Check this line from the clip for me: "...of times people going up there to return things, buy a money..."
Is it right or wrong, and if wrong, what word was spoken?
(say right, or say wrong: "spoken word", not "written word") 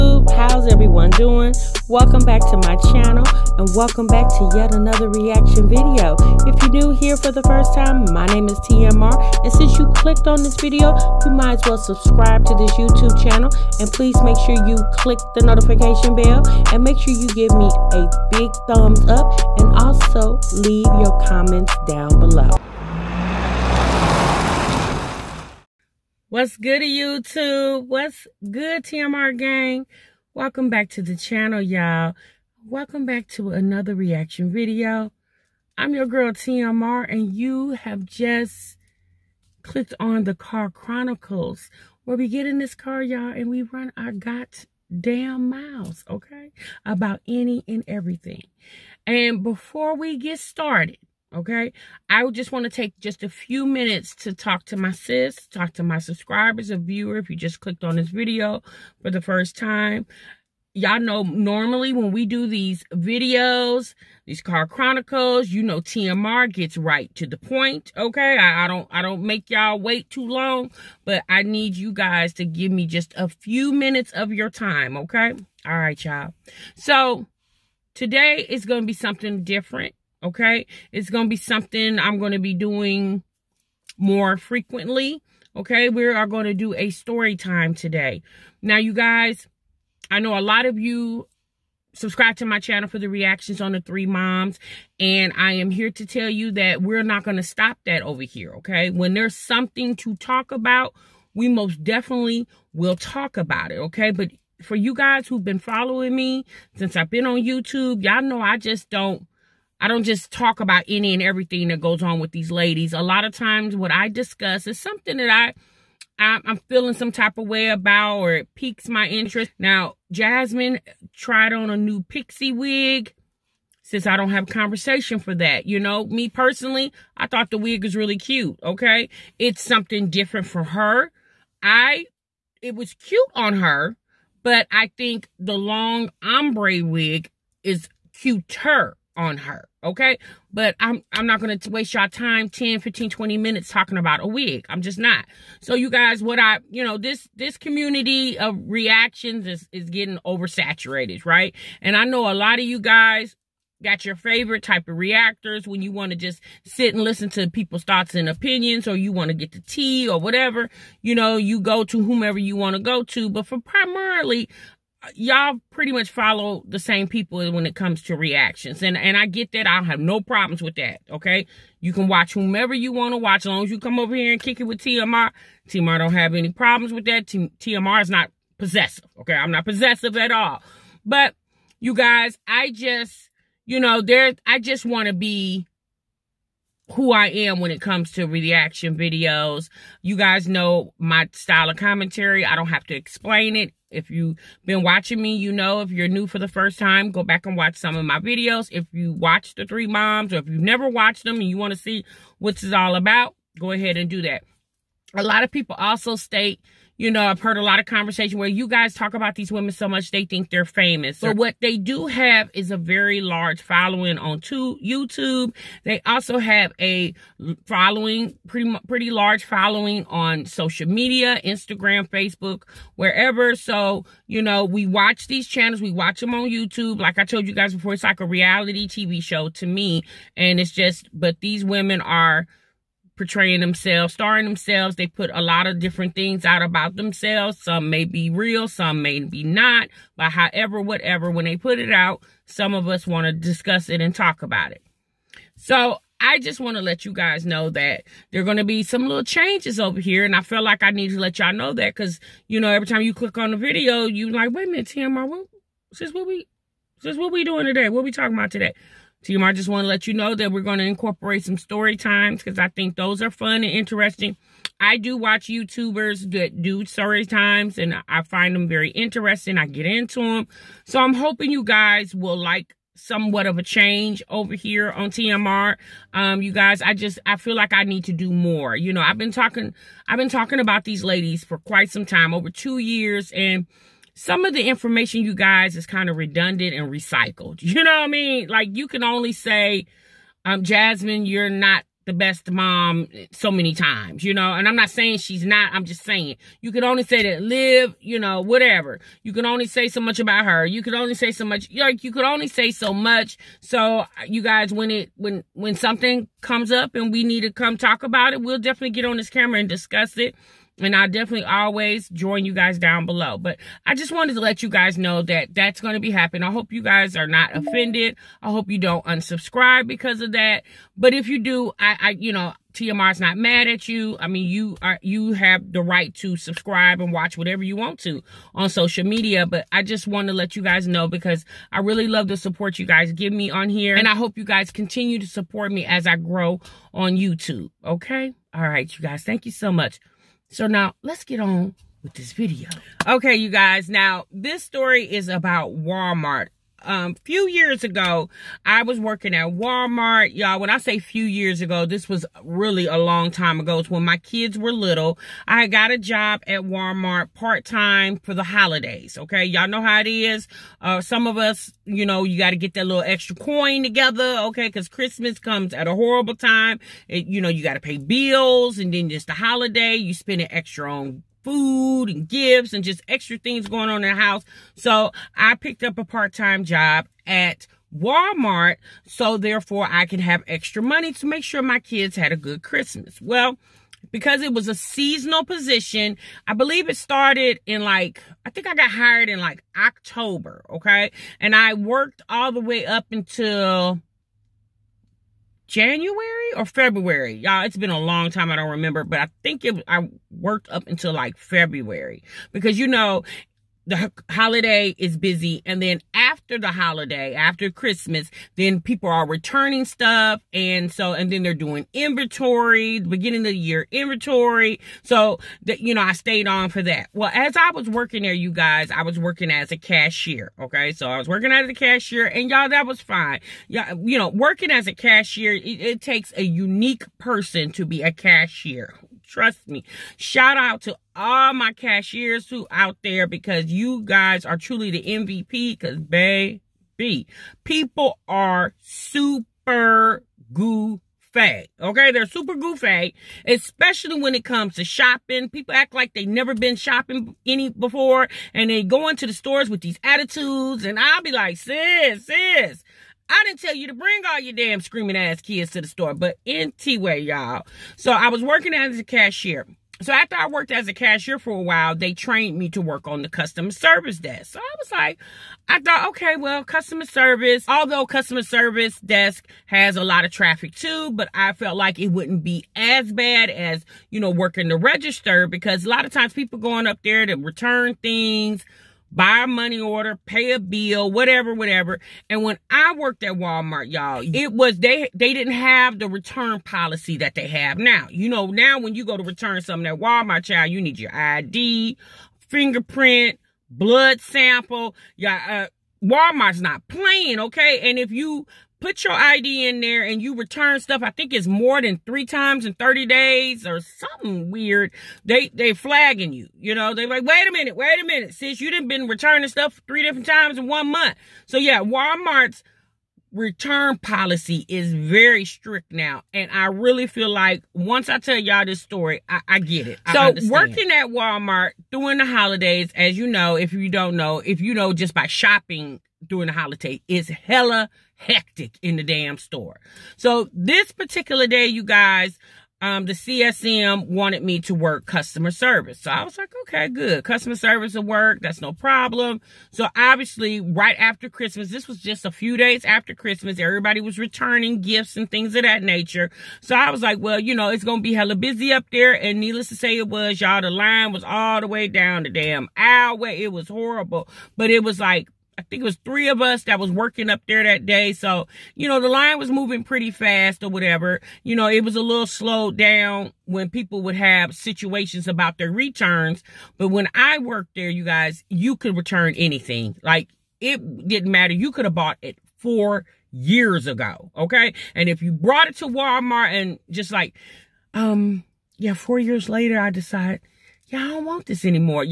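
right.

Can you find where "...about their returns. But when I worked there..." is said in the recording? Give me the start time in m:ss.
9:25.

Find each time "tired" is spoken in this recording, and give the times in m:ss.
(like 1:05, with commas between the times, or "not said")
not said.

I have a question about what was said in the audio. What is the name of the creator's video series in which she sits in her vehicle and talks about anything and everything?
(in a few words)
the Car Chronicles.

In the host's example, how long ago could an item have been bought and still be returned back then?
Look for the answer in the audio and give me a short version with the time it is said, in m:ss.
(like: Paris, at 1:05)
4 years ago, at 9:32.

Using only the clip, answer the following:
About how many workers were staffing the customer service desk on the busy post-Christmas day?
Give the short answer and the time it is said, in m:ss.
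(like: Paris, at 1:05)
3, at 9:16.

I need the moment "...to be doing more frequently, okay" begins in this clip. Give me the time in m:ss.
1:22.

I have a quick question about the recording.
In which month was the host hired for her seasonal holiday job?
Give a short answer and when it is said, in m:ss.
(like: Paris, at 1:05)
October, at 6:29.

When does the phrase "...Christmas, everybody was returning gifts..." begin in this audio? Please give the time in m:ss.
9:03.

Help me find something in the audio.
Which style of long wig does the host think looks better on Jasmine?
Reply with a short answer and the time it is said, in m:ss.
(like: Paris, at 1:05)
long ombre wig, at 2:15.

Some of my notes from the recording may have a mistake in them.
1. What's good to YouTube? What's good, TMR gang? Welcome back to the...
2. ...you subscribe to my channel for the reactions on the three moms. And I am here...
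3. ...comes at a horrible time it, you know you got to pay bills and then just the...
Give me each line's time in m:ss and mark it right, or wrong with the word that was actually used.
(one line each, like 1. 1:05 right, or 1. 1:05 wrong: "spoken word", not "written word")
1. 0:26 right
2. 1:30 right
3. 6:05 right.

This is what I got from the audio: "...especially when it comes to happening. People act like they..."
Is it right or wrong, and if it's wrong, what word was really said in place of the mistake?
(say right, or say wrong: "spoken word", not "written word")
wrong: "shopping", not "happening".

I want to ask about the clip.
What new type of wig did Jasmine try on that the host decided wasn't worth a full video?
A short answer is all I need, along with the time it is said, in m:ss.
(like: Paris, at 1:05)
pixie wig, at 2:02.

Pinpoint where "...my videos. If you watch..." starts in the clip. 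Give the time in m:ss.
3:18.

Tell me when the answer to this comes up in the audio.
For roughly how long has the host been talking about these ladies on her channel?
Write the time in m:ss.
4:42.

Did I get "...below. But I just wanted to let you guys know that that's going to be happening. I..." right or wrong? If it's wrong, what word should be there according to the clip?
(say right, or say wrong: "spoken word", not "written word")
right.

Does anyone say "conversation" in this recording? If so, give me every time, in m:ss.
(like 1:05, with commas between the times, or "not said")
2:04, 3:27.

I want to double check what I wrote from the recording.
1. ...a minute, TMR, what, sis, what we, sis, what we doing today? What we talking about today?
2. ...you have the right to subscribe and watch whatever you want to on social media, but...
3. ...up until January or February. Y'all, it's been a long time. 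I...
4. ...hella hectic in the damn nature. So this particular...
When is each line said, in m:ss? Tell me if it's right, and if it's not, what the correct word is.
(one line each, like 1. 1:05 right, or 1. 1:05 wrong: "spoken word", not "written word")
1. 4:14 right
2. 5:25 right
3. 6:32 right
4. 8:47 wrong: "store", not "nature".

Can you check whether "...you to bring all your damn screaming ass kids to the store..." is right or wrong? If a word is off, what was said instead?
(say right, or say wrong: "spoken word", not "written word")
right.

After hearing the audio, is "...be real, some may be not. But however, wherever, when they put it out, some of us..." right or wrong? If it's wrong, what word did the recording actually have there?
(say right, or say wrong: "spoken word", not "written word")
wrong: "whatever", not "wherever".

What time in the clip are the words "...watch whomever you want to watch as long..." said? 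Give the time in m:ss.
2:52.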